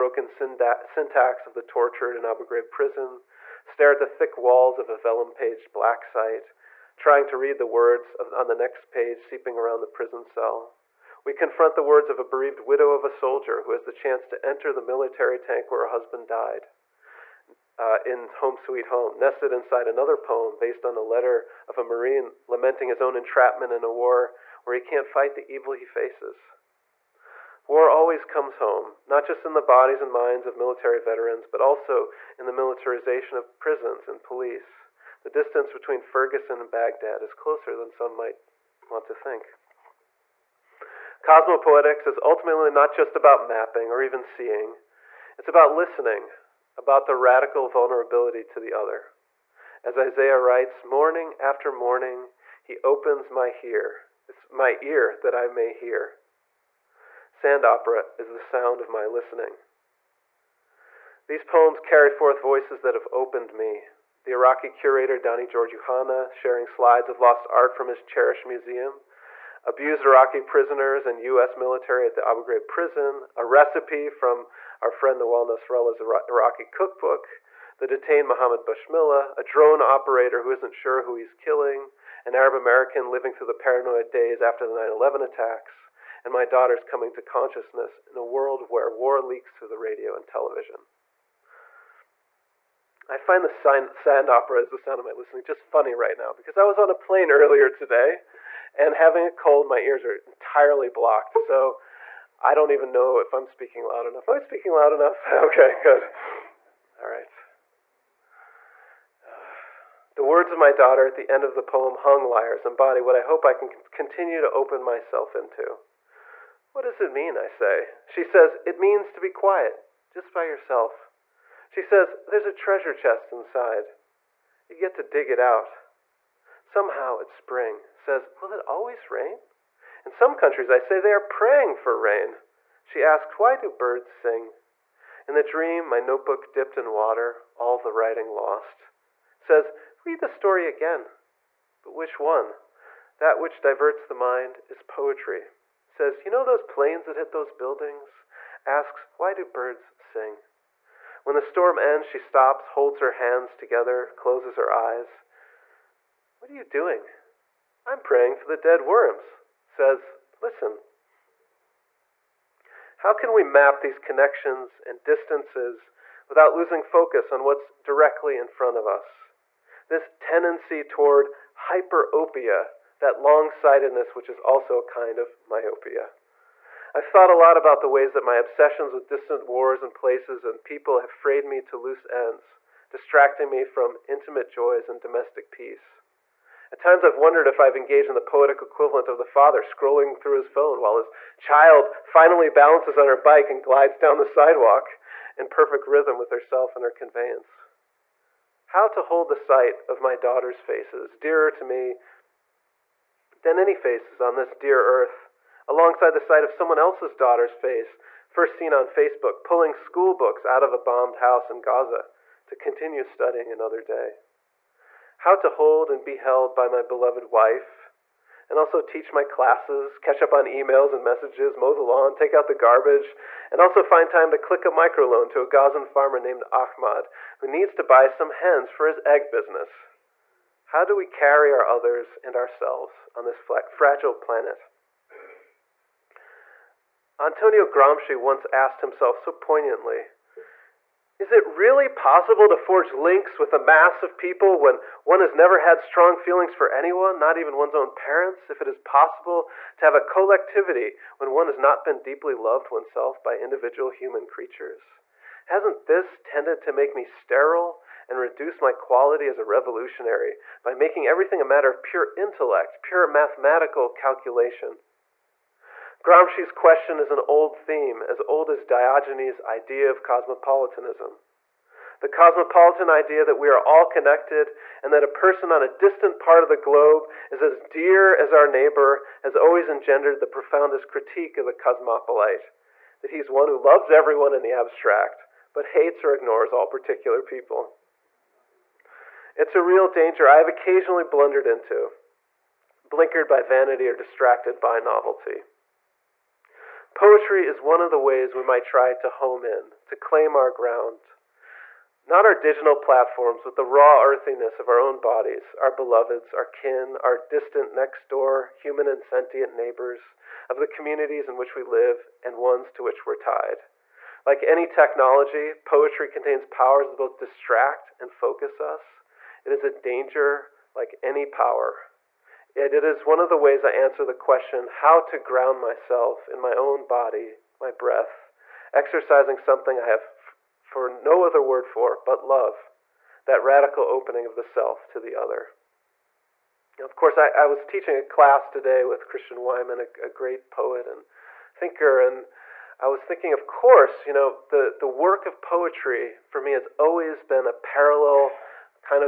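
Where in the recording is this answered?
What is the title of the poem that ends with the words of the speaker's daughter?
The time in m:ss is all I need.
1:51.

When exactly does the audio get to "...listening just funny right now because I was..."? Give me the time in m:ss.
1:35.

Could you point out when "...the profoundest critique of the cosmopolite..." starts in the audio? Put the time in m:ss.
4:40.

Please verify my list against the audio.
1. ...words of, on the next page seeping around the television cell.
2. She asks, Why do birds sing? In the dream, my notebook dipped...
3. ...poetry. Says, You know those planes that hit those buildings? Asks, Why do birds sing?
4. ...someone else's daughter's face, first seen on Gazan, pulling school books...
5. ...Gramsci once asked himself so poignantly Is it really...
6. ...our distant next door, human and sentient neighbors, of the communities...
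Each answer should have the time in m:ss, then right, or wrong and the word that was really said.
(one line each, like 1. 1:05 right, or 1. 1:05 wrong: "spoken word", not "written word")
1. 0:07 wrong: "prison", not "television"
2. 2:12 right
3. 2:24 right
4. 3:26 wrong: "Facebook", not "Gazan"
5. 3:57 right
6. 5:06 right.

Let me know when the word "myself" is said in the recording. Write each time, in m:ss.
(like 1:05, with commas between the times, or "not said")
1:54, 5:25.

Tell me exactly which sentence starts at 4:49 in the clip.
It's a real danger I have occasionally blundered into, blinkered by vanity or distracted by novelty.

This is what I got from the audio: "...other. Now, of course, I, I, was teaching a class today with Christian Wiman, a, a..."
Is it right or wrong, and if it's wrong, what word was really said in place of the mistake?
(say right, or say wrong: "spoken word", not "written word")
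right.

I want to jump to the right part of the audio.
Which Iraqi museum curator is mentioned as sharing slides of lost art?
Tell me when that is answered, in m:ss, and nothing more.
1:05.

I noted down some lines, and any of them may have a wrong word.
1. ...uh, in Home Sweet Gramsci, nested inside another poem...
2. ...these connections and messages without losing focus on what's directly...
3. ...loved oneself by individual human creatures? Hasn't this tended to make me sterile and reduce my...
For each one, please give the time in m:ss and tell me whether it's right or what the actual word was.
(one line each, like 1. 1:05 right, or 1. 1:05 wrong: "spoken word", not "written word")
1. 0:17 wrong: "Home", not "Gramsci"
2. 2:43 wrong: "distances", not "messages"
3. 4:12 right.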